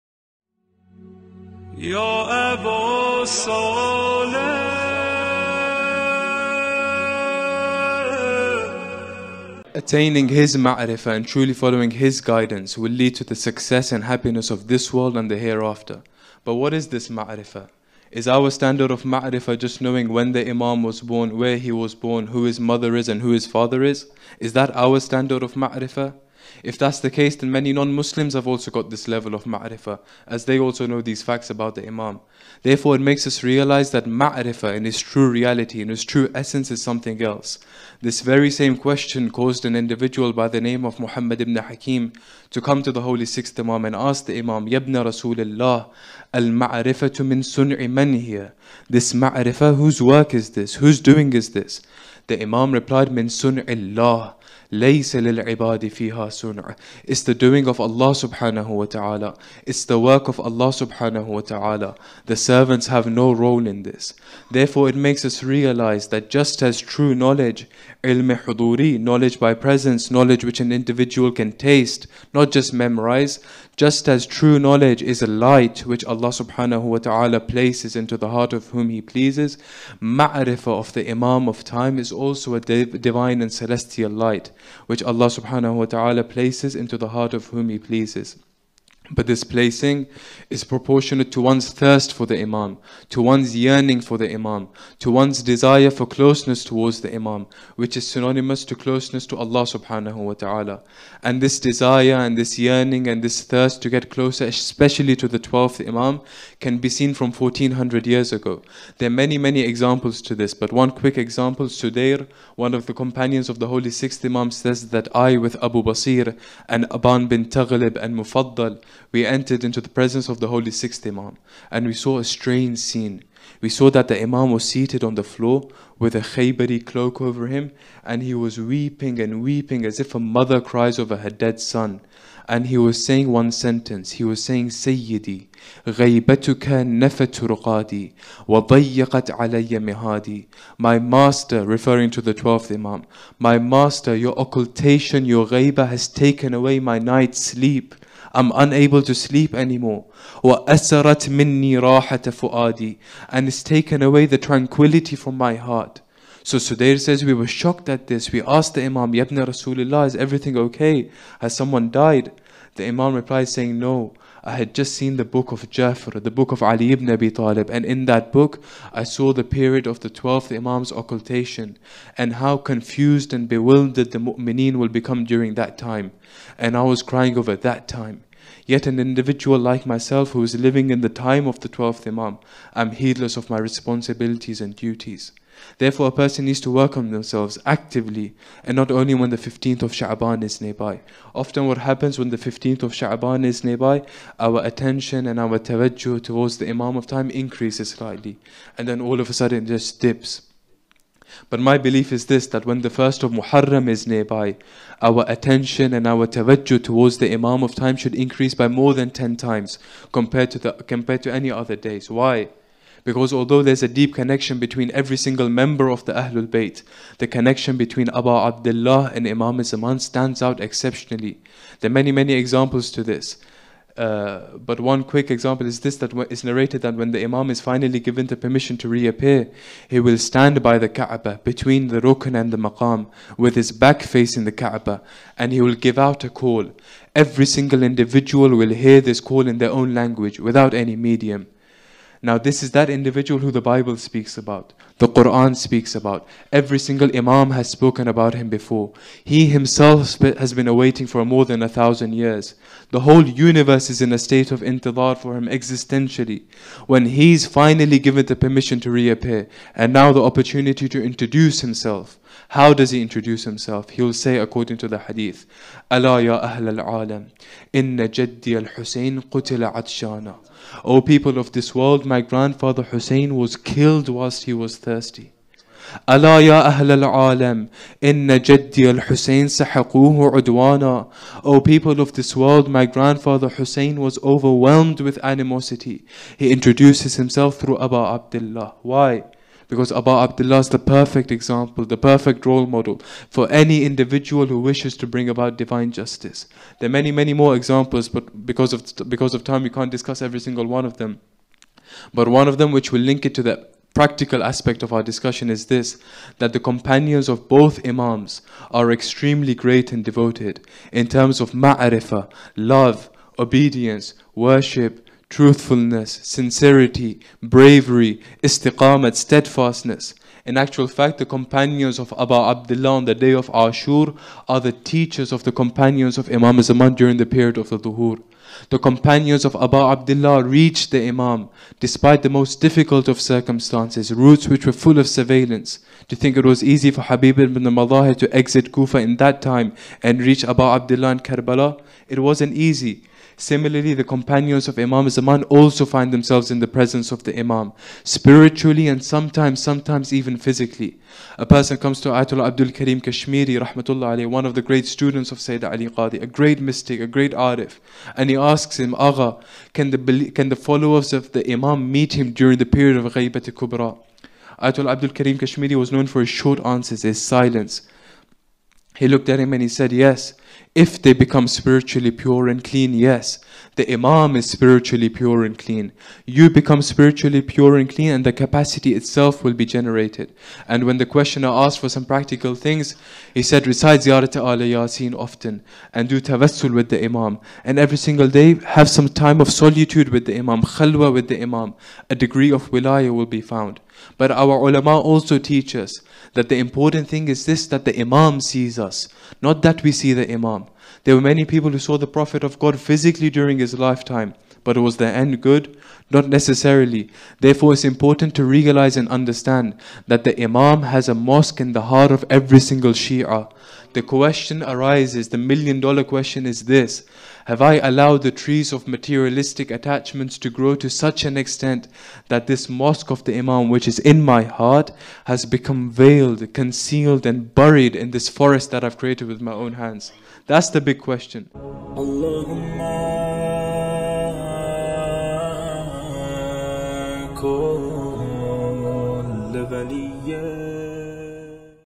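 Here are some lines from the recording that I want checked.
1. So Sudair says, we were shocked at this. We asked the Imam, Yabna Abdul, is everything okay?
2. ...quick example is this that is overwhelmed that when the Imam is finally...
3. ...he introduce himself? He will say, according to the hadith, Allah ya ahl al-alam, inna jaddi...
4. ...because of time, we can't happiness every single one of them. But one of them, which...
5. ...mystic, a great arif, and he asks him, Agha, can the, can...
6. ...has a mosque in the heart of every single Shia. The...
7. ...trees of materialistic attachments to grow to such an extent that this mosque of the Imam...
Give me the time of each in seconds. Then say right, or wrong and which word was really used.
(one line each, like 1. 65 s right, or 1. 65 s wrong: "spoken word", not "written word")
1. 156 s wrong: "Rasulullah", not "Abdul"
2. 225 s wrong: "narrated", not "overwhelmed"
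3. 262 s right
4. 299 s wrong: "discuss", not "happiness"
5. 356 s right
6. 410 s right
7. 418 s right.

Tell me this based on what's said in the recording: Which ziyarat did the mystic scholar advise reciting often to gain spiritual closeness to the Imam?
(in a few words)
Ziyarat al Yasin.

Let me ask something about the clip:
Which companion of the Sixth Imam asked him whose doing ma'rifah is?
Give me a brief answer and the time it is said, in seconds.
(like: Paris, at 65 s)
Muhammad ibn Hakim, at 40 s.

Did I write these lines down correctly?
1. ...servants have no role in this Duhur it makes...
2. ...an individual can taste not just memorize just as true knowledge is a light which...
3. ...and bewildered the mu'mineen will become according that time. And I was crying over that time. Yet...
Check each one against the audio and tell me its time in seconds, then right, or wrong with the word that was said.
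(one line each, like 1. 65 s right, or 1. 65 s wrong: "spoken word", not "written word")
1. 62 s wrong: "Therefore", not "Duhur"
2. 70 s right
3. 173 s wrong: "during", not "according".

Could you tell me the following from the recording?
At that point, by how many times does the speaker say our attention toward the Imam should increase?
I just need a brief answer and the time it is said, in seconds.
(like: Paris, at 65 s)
10, at 209 s.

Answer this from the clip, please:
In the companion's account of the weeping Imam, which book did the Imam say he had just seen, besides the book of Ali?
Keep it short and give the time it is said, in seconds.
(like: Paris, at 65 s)
Book of Jafar, at 165 s.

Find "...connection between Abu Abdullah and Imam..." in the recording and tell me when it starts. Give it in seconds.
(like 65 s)
217 s.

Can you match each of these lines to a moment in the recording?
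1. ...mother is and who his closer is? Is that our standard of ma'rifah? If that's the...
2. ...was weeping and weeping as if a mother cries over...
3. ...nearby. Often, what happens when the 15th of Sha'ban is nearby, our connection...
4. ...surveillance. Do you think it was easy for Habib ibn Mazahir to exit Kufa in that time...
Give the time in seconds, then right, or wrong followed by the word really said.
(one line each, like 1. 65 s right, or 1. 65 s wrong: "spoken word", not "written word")
1. 22 s wrong: "father", not "closer"
2. 128 s right
3. 190 s wrong: "attention", not "connection"
4. 335 s right.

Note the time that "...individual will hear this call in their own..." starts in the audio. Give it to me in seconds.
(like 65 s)
237 s.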